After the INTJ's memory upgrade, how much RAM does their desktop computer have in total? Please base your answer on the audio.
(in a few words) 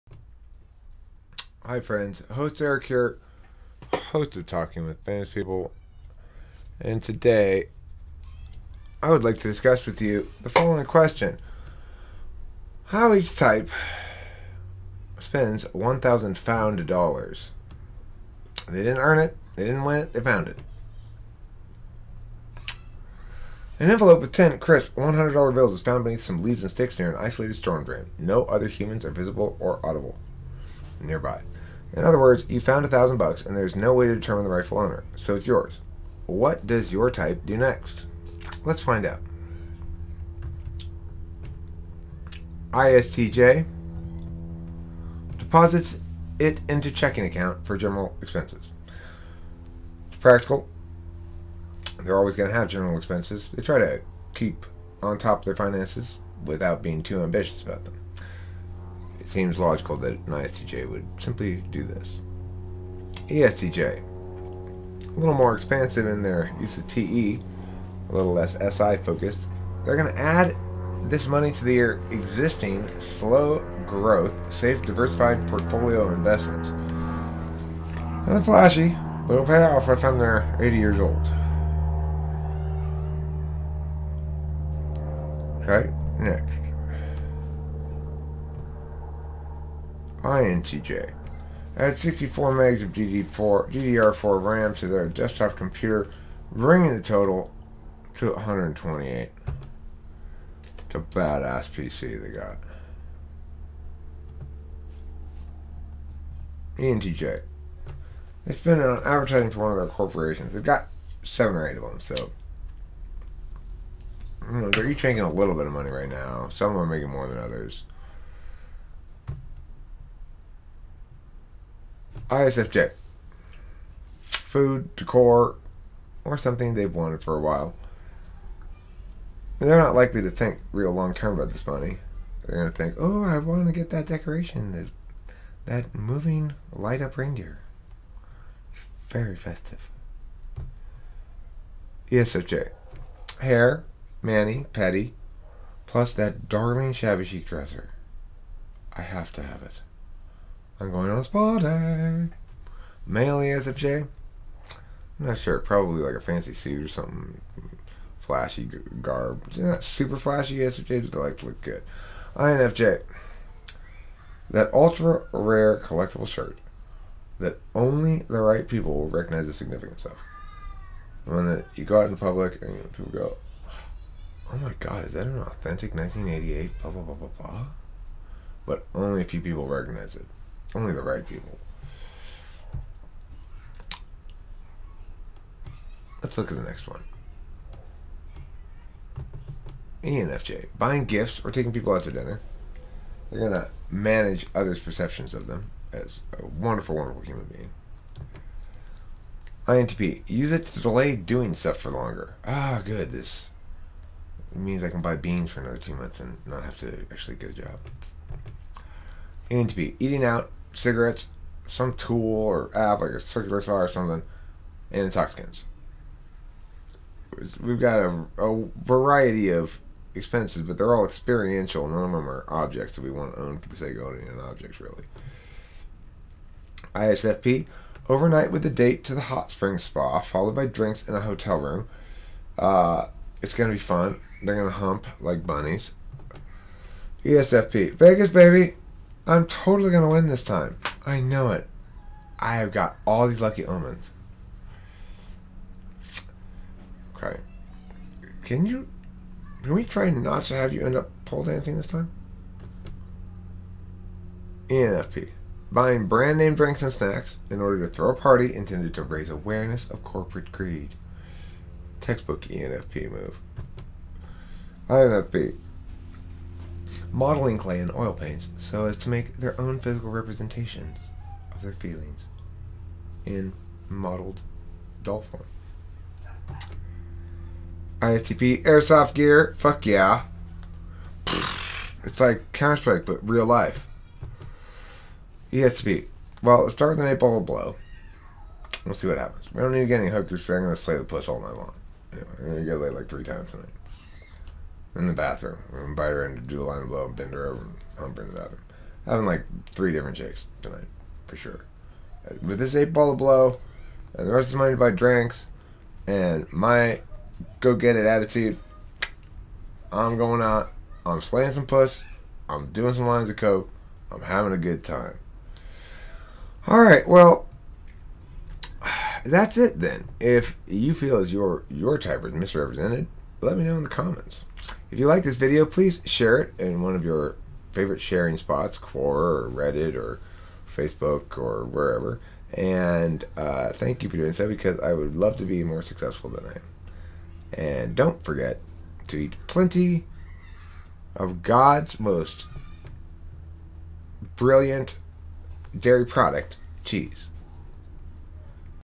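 128.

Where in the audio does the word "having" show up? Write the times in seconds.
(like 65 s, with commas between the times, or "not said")
299 s, 314 s.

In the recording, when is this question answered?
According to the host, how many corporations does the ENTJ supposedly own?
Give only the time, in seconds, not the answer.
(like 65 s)
111 s.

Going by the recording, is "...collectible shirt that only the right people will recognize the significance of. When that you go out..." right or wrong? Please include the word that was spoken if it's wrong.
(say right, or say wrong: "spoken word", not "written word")
right.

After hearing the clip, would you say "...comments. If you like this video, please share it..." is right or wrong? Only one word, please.
right.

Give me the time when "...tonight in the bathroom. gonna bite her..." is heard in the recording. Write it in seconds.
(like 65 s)
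293 s.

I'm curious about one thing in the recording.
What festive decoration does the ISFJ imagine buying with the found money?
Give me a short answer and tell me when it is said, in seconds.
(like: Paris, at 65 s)
Light up reindeer, at 135 s.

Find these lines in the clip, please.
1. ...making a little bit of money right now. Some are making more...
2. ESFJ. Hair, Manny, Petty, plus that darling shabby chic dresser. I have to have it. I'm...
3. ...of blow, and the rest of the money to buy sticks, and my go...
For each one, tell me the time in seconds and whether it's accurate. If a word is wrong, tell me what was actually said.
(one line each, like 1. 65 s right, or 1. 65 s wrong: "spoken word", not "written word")
1. 115 s right
2. 142 s right
3. 303 s wrong: "drinks", not "sticks".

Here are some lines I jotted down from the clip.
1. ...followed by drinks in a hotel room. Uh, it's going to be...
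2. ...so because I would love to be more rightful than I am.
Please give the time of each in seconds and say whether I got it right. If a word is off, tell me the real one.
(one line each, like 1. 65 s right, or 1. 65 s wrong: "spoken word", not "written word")
1. 230 s right
2. 334 s wrong: "successful", not "rightful".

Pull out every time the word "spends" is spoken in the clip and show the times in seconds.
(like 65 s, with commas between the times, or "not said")
15 s, 108 s.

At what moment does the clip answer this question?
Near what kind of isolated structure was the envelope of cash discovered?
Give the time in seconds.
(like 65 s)
27 s.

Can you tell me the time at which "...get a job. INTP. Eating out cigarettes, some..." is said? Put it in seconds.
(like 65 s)
207 s.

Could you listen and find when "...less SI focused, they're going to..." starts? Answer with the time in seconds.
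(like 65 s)
68 s.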